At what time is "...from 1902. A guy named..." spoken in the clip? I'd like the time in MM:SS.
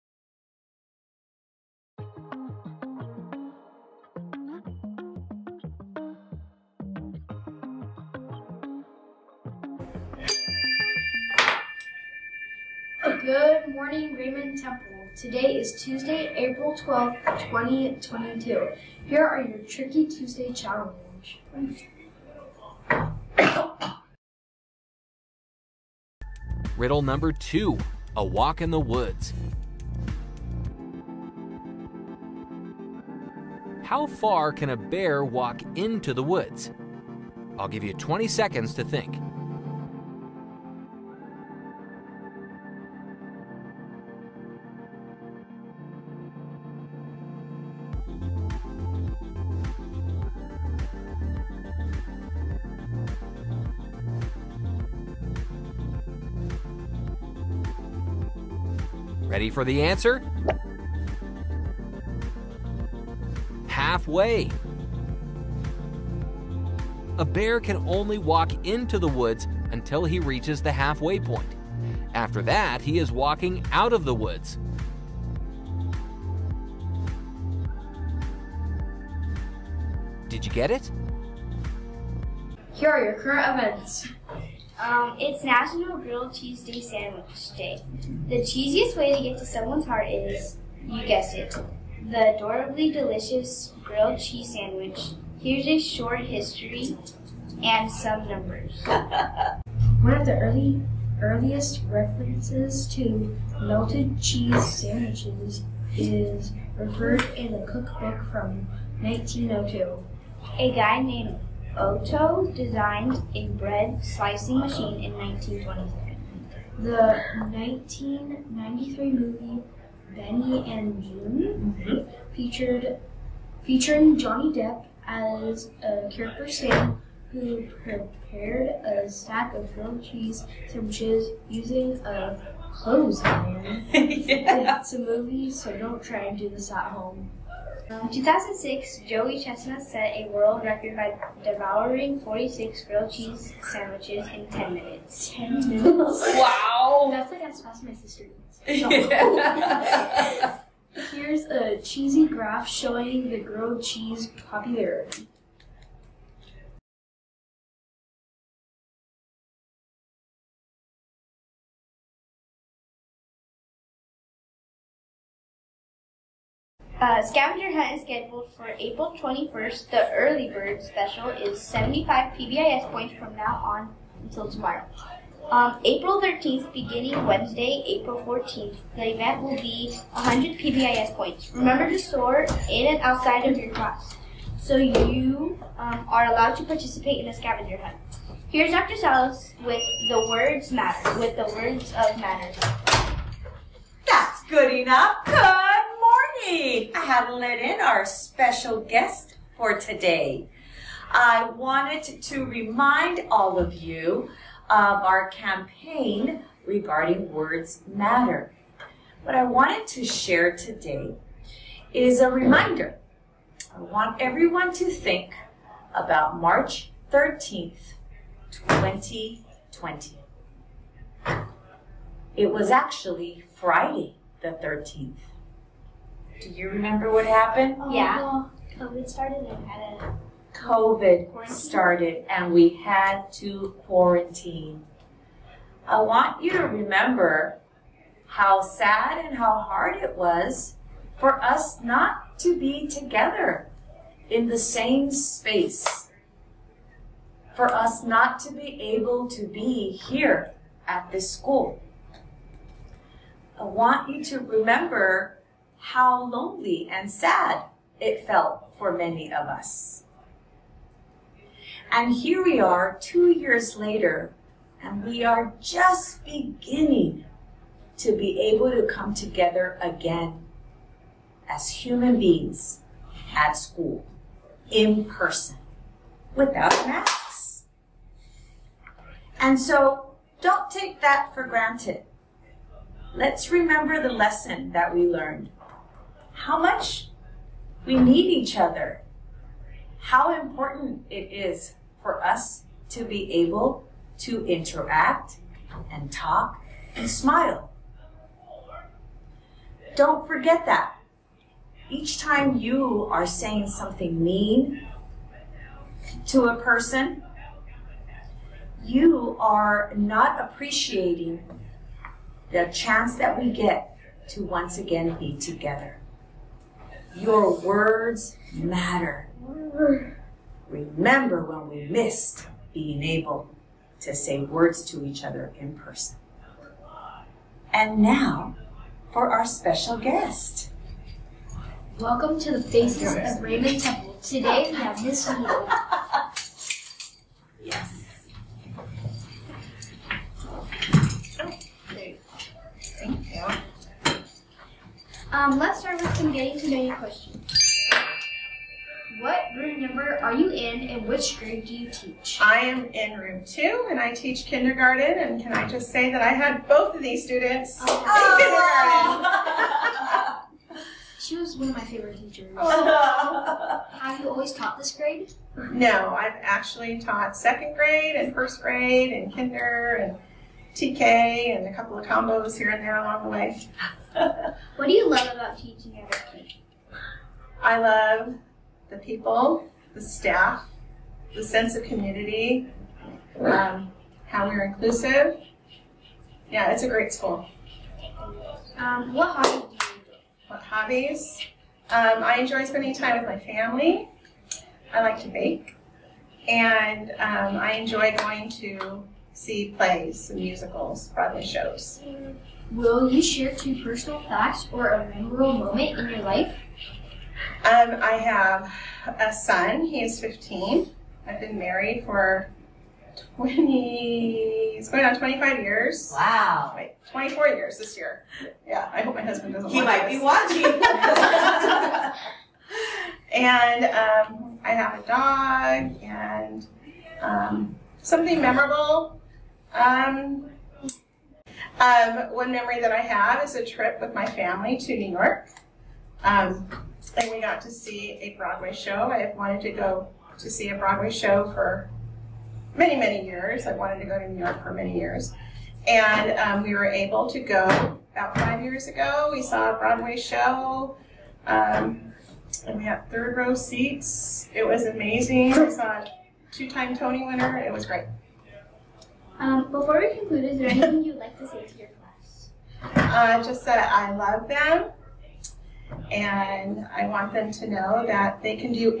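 01:48.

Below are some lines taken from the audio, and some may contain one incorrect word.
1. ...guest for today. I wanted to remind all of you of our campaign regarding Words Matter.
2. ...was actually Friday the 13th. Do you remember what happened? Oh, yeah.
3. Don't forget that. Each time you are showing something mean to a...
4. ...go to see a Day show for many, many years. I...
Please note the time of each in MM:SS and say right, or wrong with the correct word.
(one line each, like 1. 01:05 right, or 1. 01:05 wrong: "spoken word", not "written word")
1. 03:18 right
2. 03:42 right
3. 04:59 wrong: "saying", not "showing"
4. 07:19 wrong: "Broadway", not "Day".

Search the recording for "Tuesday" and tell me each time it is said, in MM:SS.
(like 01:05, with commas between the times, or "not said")
00:15, 00:20.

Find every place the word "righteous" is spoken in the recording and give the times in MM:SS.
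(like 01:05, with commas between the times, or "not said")
not said.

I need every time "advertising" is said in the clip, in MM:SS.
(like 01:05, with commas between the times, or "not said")
not said.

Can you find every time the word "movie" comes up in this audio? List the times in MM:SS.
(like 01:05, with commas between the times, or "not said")
01:59, 02:14.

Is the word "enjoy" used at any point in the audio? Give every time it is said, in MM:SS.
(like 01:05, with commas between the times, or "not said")
06:32, 06:37.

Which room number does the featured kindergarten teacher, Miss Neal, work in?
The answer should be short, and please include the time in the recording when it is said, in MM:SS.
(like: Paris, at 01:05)
2, at 05:53.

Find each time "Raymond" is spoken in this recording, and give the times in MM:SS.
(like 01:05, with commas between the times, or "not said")
00:14, 05:33.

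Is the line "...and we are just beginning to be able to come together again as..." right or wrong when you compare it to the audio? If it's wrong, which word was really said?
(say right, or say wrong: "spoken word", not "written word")
right.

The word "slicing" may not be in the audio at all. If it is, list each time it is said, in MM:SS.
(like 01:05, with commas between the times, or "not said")
01:54.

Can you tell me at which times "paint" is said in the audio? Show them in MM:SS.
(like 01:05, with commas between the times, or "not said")
not said.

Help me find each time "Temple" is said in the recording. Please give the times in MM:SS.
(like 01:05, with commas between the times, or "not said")
00:14, 05:33.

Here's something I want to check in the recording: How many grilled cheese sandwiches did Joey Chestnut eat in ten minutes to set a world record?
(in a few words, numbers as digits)
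46.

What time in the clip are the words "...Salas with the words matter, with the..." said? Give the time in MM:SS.
03:08.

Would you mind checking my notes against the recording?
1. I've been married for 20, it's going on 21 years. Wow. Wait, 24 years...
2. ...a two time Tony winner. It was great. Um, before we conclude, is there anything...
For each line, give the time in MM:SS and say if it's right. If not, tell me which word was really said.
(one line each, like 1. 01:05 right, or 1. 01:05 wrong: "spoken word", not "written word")
1. 06:51 wrong: "25", not "21"
2. 07:35 right.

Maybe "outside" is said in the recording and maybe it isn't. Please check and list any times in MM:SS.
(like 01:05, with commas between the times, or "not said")
03:03.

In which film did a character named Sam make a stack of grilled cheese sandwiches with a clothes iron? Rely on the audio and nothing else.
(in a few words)
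Benny and Joon.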